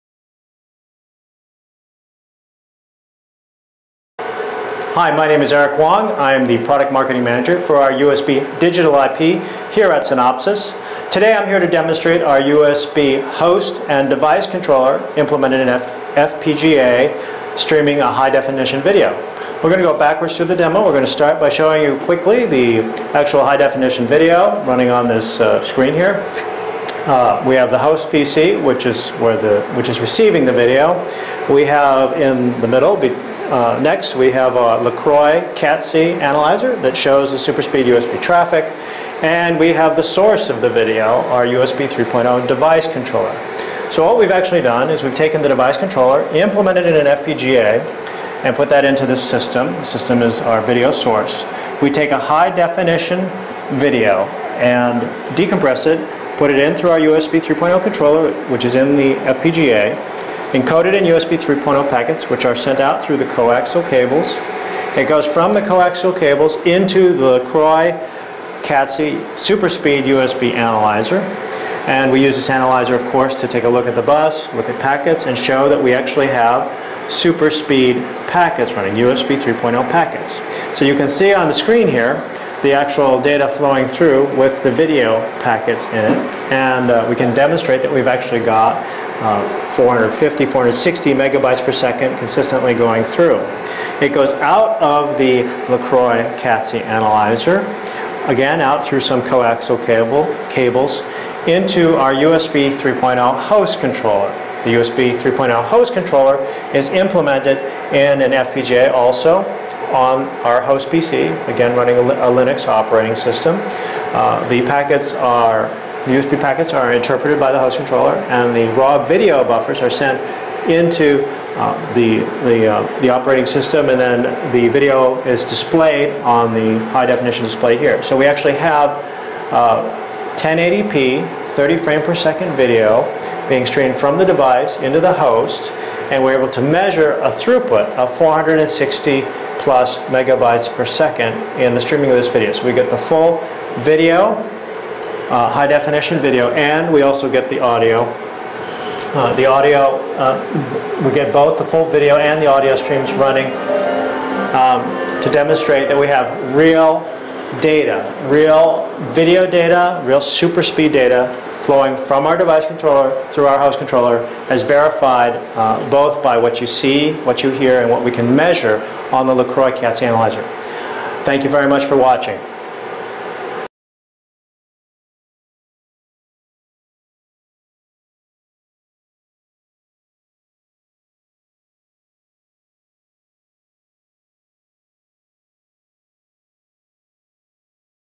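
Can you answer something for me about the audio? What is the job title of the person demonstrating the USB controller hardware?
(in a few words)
Product Marketing Manager.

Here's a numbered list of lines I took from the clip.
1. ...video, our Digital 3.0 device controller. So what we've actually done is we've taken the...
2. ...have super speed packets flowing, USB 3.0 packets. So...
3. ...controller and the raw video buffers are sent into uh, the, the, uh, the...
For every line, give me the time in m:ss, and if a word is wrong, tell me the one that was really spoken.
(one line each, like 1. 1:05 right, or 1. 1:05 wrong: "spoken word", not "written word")
1. 0:40 wrong: "USB", not "Digital"
2. 1:16 wrong: "running", not "flowing"
3. 1:57 right.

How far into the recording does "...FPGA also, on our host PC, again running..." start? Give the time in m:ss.
1:48.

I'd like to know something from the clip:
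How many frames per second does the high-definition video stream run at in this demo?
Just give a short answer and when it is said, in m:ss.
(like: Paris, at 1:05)
30, at 2:11.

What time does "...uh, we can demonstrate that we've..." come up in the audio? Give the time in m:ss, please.
1:26.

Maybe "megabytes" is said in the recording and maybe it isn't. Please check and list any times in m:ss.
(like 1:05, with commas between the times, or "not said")
1:31, 2:20.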